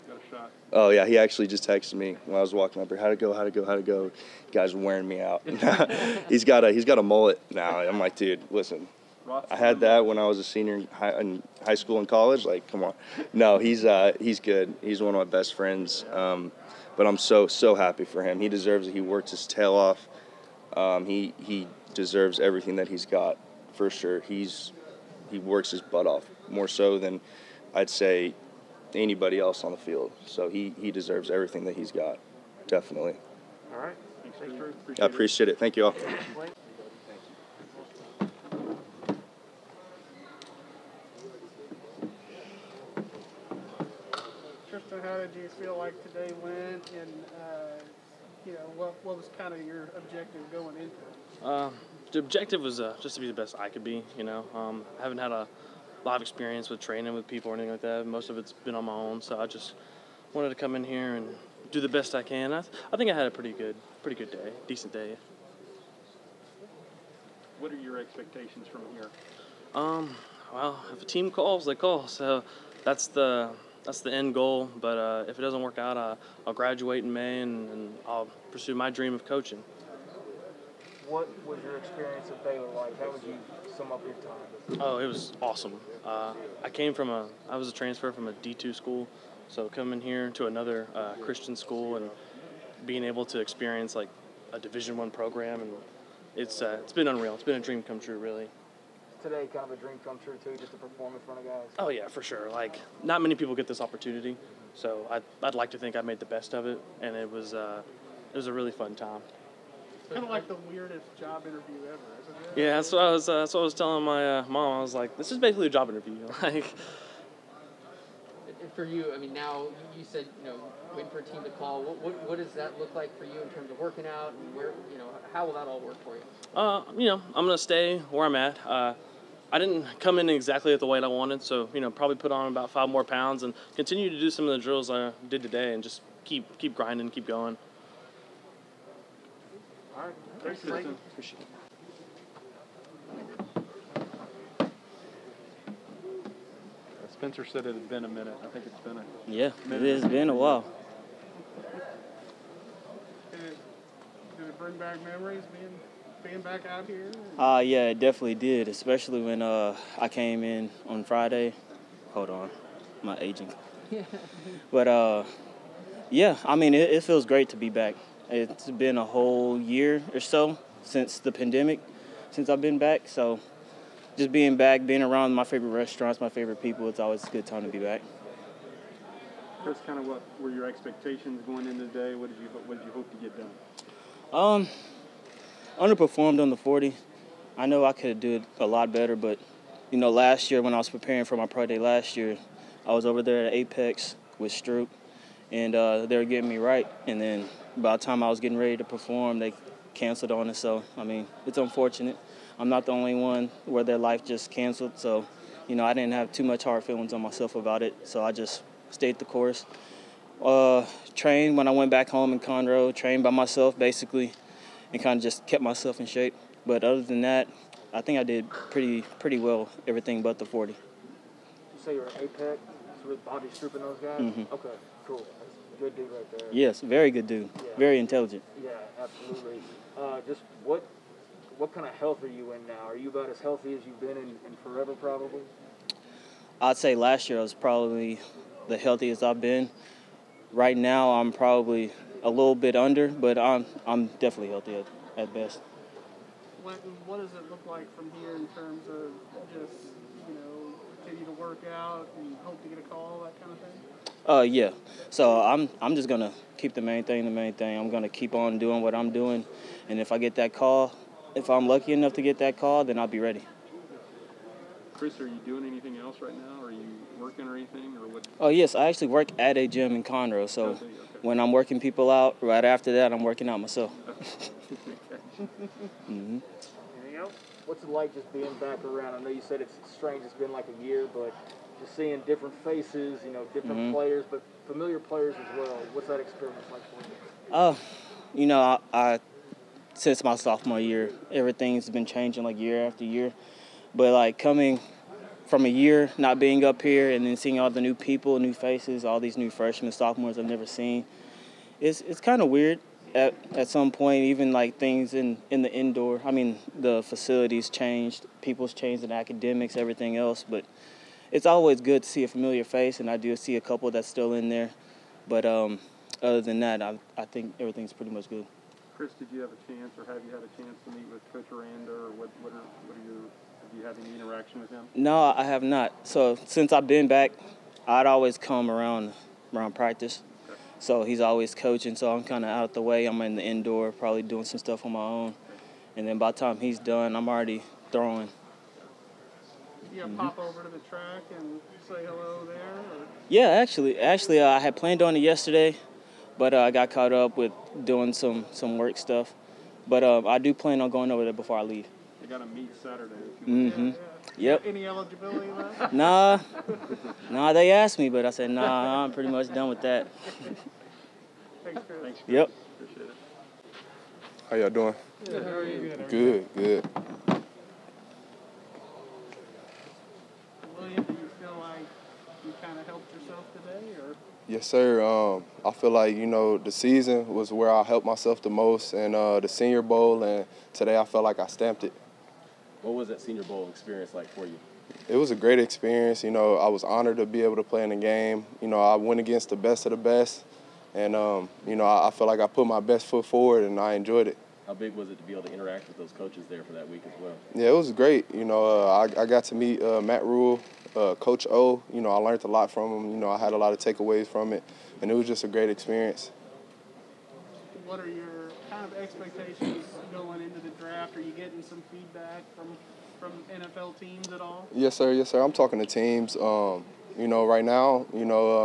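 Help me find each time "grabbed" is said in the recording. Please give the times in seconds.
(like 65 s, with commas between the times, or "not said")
not said.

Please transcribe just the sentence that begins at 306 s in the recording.
I mean, the facilities changed, people's changed in academics, everything else.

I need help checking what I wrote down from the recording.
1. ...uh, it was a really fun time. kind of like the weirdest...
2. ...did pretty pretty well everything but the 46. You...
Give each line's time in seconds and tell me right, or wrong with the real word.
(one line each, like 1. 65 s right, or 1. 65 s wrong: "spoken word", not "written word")
1. 107 s right
2. 218 s wrong: "40", not "46".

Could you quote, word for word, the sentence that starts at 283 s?
players, but familiar players as well.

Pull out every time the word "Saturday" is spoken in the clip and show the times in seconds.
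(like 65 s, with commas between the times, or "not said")
352 s.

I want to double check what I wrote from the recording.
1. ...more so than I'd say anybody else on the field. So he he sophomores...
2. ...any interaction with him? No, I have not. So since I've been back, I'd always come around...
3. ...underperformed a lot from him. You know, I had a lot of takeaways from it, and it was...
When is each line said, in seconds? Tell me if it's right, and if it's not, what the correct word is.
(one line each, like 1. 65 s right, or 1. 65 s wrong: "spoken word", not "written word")
1. 26 s wrong: "deserves", not "sophomores"
2. 324 s right
3. 402 s wrong: "learned", not "underperformed".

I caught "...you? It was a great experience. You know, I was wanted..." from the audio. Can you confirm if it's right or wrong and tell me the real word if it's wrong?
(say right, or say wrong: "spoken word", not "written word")
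wrong: "honored", not "wanted".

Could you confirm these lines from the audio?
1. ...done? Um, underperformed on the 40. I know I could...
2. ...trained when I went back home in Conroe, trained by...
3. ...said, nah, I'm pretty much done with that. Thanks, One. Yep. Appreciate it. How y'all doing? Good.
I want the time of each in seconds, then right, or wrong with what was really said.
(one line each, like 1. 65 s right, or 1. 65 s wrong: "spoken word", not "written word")
1. 183 s right
2. 211 s right
3. 358 s wrong: "Chris", not "One".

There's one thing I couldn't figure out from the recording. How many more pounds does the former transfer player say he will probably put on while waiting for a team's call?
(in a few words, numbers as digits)
5.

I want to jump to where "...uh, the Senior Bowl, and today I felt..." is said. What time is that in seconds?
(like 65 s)
379 s.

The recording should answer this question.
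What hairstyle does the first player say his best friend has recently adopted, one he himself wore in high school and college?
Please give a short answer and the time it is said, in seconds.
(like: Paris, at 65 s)
Mullet, at 7 s.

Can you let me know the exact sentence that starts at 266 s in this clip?
Are you working or anything, or what?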